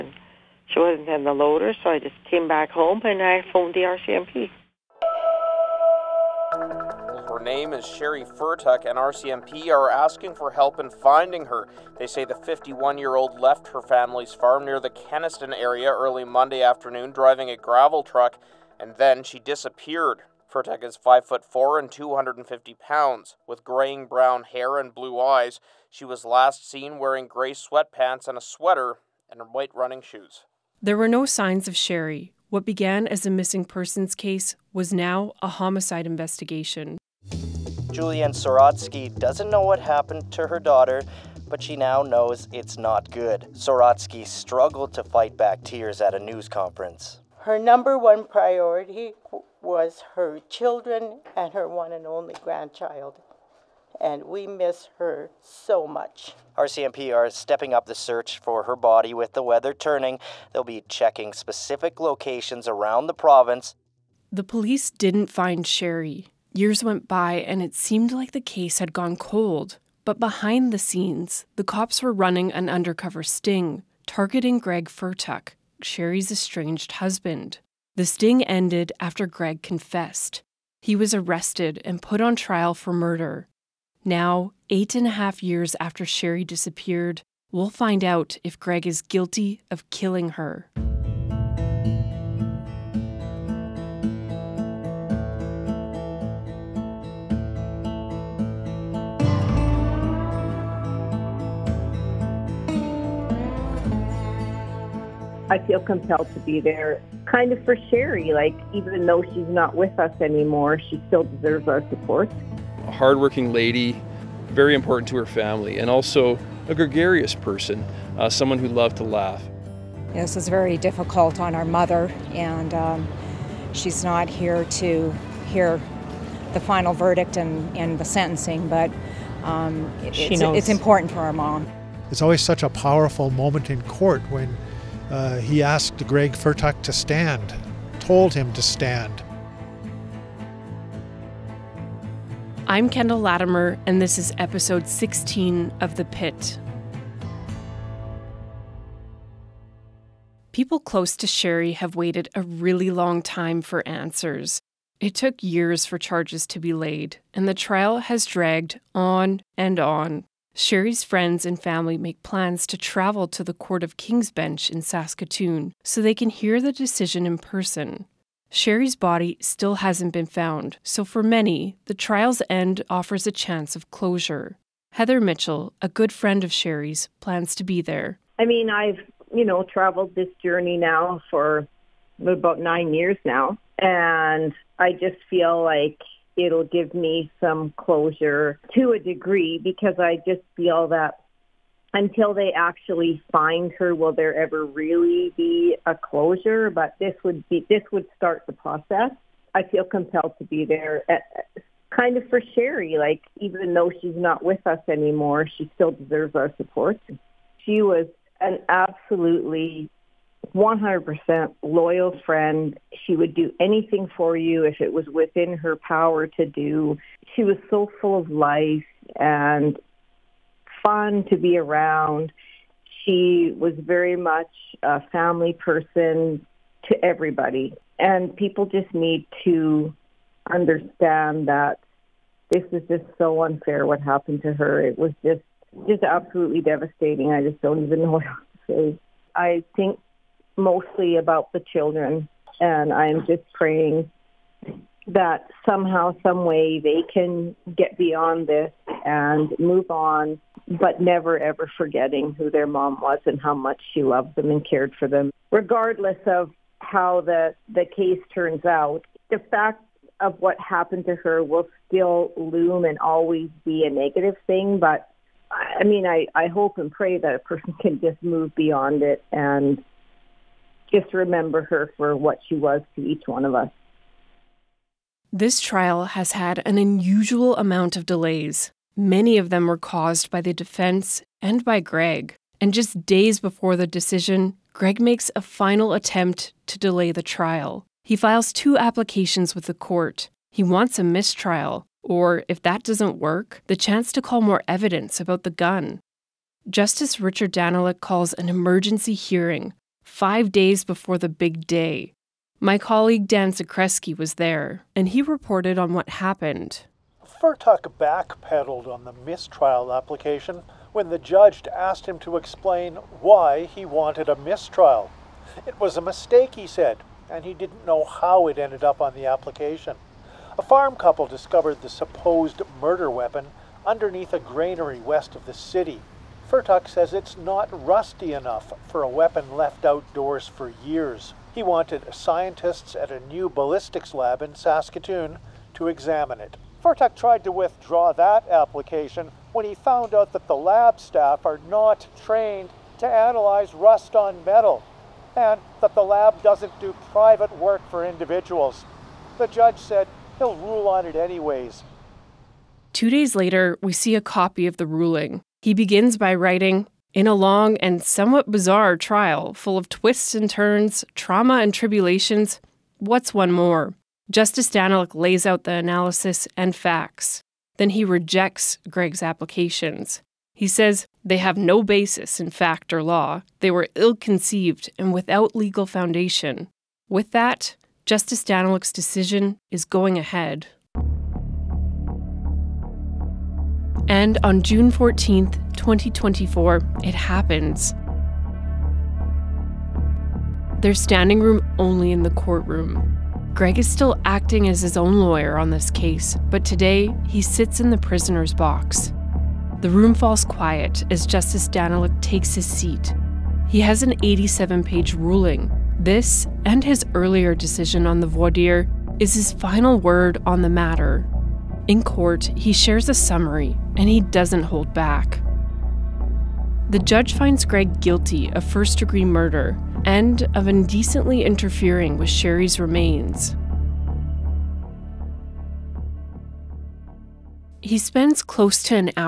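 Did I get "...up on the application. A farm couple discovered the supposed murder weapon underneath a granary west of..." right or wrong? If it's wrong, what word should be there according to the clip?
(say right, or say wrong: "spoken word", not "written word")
right.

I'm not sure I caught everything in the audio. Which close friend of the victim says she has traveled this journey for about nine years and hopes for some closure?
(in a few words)
Heather Mitchell.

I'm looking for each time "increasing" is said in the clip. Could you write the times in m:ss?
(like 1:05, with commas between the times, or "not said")
not said.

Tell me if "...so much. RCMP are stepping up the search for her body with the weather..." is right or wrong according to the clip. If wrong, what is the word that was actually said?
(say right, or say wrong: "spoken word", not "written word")
right.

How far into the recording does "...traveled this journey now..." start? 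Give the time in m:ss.
2:59.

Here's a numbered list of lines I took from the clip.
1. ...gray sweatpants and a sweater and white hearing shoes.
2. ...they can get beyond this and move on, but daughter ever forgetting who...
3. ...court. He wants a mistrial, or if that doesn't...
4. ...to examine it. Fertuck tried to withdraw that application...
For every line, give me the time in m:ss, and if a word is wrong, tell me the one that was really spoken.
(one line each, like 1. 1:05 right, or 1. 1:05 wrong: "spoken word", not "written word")
1. 0:27 wrong: "running", not "hearing"
2. 4:06 wrong: "never", not "daughter"
3. 4:49 right
4. 5:35 right.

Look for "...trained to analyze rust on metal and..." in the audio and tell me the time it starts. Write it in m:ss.
5:42.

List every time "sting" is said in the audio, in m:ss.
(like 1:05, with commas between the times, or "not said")
1:13, 1:18.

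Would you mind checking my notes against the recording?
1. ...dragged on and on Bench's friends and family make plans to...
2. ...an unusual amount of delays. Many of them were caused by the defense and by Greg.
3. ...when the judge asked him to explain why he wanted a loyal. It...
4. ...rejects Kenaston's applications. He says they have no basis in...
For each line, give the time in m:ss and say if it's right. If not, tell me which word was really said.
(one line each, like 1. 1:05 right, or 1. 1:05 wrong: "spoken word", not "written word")
1. 2:38 wrong: "Sheree", not "Bench"
2. 4:36 right
3. 5:10 wrong: "mistrial", not "loyal"
4. 6:08 wrong: "Greg", not "Kenaston".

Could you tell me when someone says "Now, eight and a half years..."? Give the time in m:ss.
1:24.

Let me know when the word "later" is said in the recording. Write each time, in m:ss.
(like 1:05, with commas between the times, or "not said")
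5:53.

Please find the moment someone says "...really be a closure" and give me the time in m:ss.
3:14.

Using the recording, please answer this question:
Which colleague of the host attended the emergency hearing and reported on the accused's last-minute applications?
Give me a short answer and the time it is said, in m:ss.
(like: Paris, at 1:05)
Dan Zakreski, at 5:03.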